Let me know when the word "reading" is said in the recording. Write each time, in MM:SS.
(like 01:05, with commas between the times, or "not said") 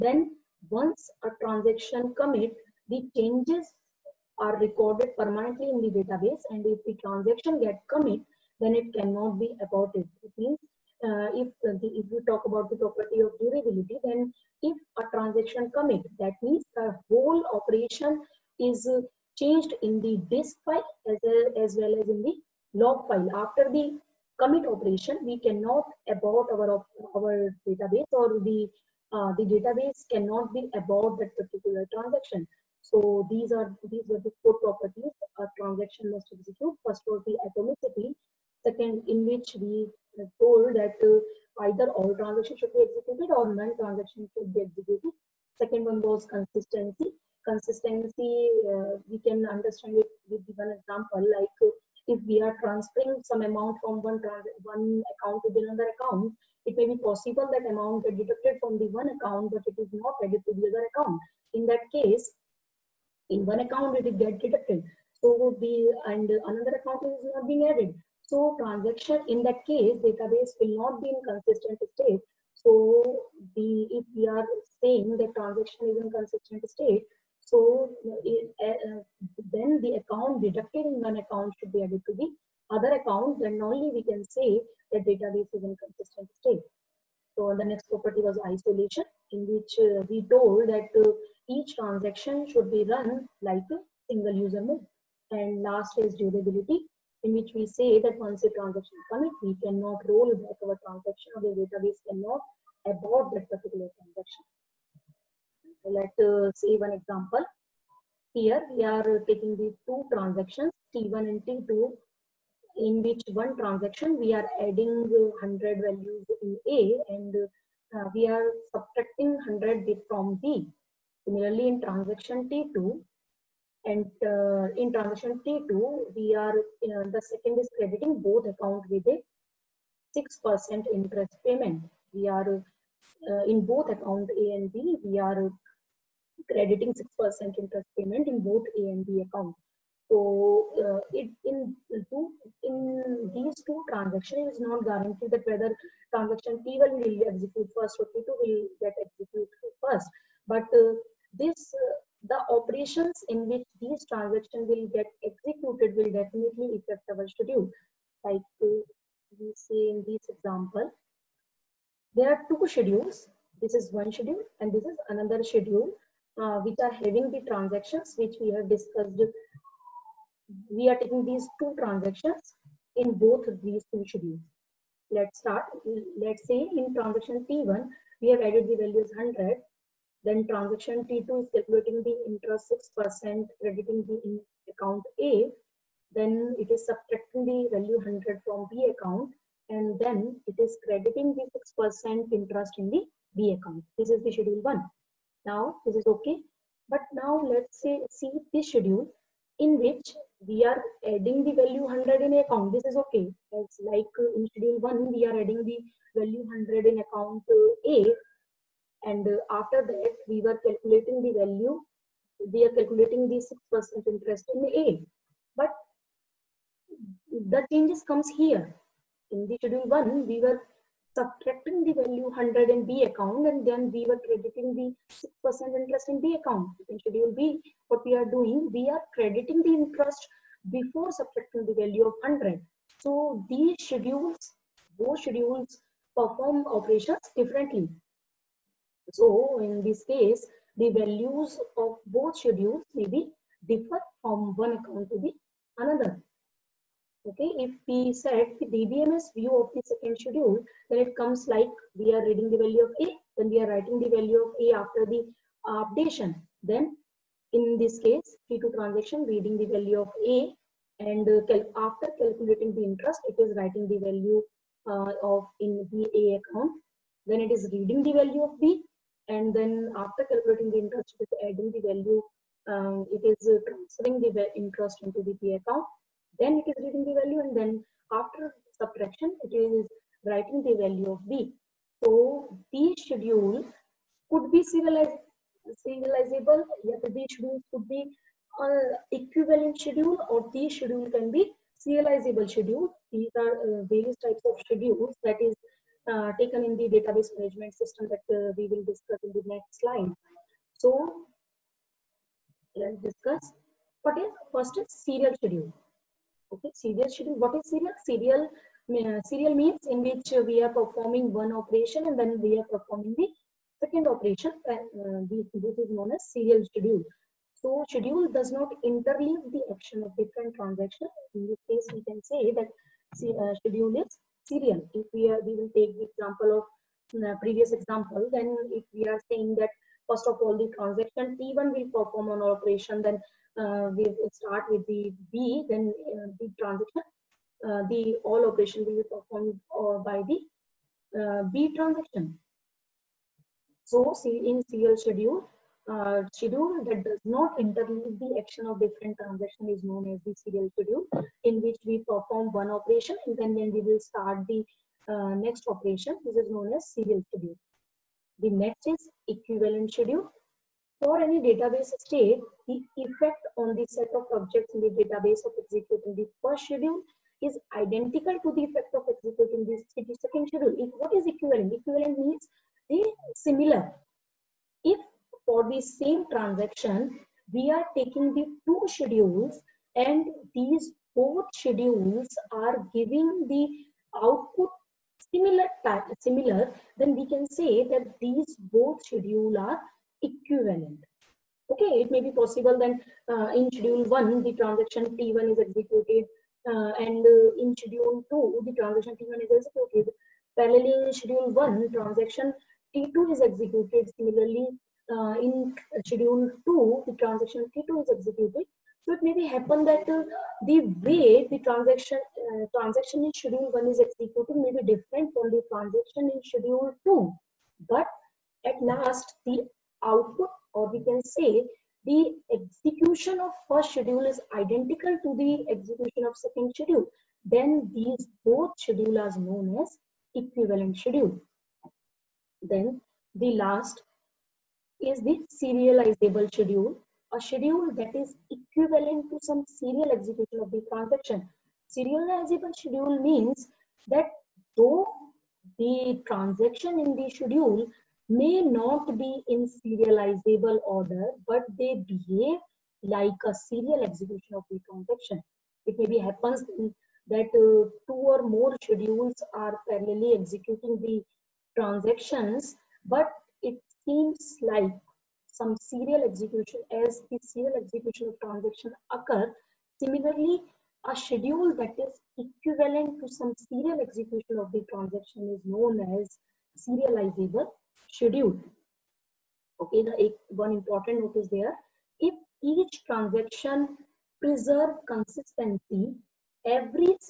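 04:12, 04:19, 04:27, 04:36.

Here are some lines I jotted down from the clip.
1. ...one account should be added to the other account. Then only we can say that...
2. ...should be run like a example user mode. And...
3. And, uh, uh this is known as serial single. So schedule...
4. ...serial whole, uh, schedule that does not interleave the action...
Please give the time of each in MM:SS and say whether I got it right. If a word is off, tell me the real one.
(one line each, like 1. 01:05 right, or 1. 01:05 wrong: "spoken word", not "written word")
1. 01:21 right
2. 01:32 wrong: "single", not "example"
3. 05:14 wrong: "schedule", not "single"
4. 05:44 wrong: "schedule", not "whole".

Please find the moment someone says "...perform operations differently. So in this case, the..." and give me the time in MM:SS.
03:56.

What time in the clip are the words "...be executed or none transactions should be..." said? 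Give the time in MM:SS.
00:42.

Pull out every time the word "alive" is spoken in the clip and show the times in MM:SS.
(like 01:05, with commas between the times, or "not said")
not said.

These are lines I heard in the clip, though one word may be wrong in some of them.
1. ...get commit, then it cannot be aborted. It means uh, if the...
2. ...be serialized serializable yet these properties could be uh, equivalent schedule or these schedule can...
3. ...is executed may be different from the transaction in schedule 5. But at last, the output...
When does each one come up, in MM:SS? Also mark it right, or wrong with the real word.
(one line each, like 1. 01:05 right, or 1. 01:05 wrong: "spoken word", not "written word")
1. 00:07 right
2. 04:44 wrong: "schedules", not "properties"
3. 06:53 wrong: "2", not "5".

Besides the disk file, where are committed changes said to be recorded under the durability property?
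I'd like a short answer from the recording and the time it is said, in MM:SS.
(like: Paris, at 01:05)
log file, at 00:22.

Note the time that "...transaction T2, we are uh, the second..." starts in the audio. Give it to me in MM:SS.
02:04.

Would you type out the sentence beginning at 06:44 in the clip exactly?
Similarly, uh, in schedule 2, the transaction T2 is executed.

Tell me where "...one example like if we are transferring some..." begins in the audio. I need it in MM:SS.
00:50.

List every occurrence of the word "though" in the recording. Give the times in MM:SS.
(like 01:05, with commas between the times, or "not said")
07:24.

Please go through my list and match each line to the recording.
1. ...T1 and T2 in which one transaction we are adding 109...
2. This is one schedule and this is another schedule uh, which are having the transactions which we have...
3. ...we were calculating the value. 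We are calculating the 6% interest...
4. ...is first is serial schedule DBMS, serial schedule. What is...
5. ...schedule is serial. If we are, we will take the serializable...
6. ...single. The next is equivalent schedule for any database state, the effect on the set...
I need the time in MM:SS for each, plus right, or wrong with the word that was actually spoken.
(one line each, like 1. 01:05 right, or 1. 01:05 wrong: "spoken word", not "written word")
1. 01:50 wrong: "100", not "109"
2. 02:43 right
3. 03:30 right
4. 05:04 wrong: "Okay", not "DBMS"
5. 05:23 wrong: "example", not "serializable"
6. 05:57 wrong: "schedule", not "single".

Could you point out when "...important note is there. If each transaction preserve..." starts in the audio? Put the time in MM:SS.
08:00.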